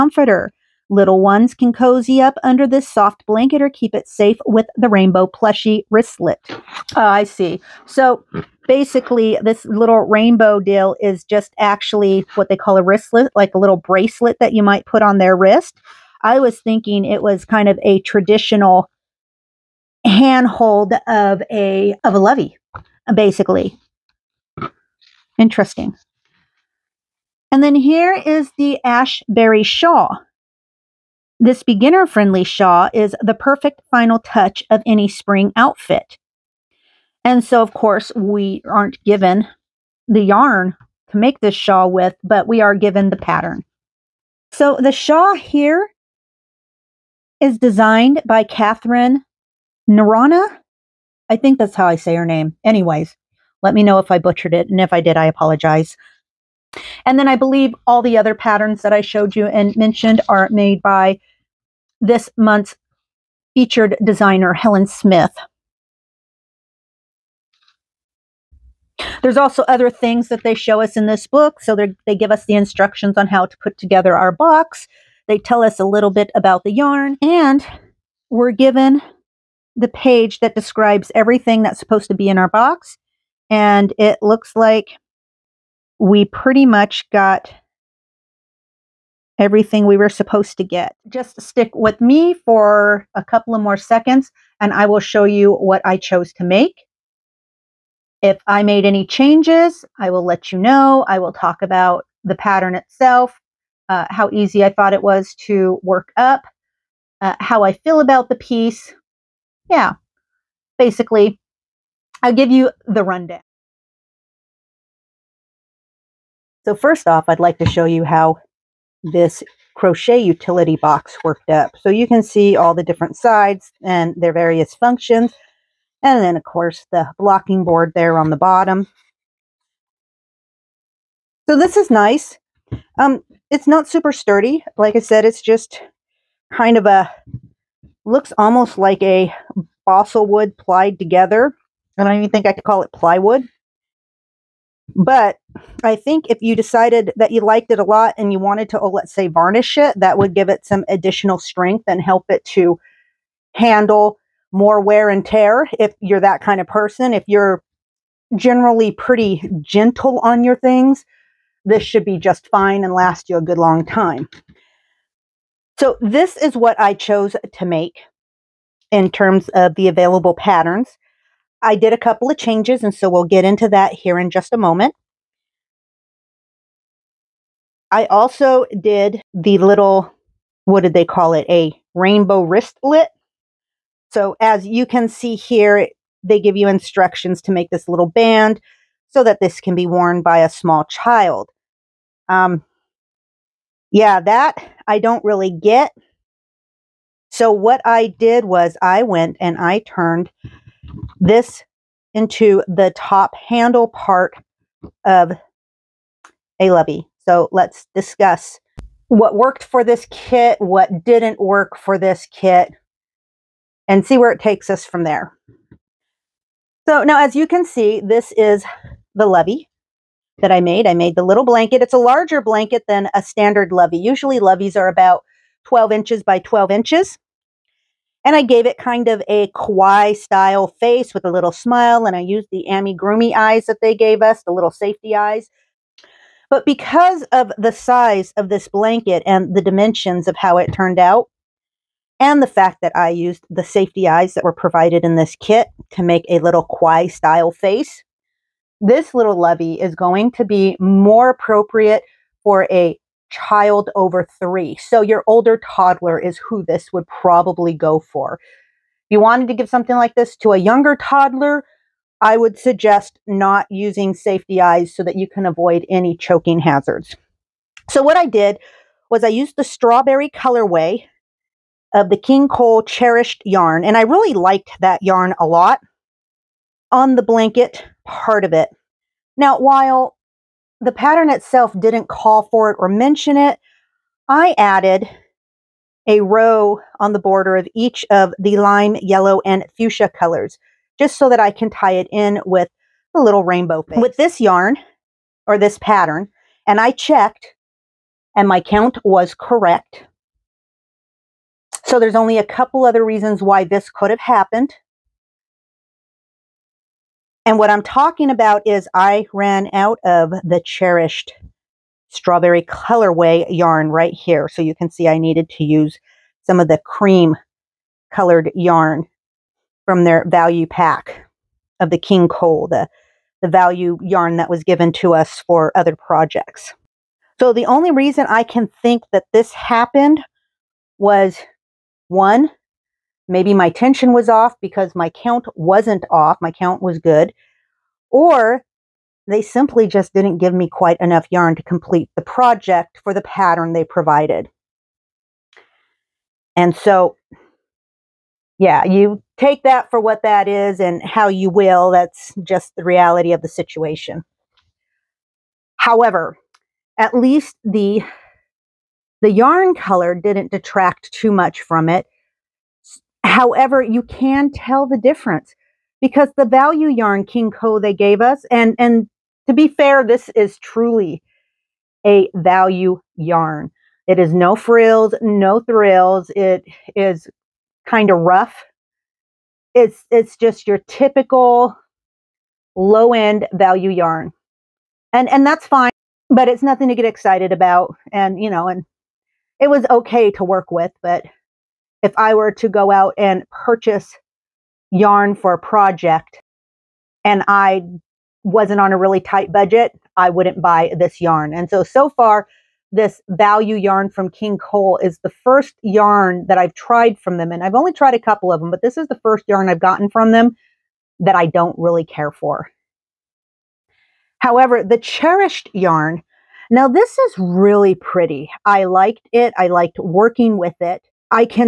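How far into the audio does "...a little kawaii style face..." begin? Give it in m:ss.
4:06.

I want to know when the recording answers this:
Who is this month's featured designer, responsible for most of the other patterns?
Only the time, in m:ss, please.
1:04.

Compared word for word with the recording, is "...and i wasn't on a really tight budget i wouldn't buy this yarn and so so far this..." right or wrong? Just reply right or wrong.
right.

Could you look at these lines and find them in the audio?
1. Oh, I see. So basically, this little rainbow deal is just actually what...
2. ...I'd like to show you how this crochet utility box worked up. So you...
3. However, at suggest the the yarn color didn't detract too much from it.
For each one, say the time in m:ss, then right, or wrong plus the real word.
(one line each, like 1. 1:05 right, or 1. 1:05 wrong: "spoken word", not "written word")
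1. 0:06 right
2. 1:57 right
3. 5:55 wrong: "least", not "suggest".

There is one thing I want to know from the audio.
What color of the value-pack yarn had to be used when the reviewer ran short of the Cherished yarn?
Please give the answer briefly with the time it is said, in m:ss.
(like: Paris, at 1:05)
cream, at 5:16.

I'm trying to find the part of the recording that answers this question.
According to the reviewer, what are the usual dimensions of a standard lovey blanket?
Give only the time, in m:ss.
3:45.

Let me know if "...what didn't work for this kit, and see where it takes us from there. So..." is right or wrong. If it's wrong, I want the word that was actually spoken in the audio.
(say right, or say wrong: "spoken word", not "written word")
right.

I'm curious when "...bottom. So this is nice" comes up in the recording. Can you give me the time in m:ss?
2:08.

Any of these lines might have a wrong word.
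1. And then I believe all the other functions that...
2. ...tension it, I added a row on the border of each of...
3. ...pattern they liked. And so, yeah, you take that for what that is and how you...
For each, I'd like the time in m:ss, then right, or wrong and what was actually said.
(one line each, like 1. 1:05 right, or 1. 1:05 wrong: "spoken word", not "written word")
1. 0:57 wrong: "patterns", not "functions"
2. 4:42 wrong: "mention", not "tension"
3. 5:43 wrong: "provided", not "liked".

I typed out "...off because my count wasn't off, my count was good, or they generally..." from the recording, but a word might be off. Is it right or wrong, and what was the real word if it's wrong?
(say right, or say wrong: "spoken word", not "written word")
wrong: "simply", not "generally".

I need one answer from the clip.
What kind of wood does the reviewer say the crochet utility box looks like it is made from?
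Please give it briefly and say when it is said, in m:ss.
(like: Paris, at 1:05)
balsa wood, at 2:19.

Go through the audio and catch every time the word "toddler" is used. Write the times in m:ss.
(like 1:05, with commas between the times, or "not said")
4:15, 4:20.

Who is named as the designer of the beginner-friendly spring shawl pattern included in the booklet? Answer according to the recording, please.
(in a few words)
Catherine Narana.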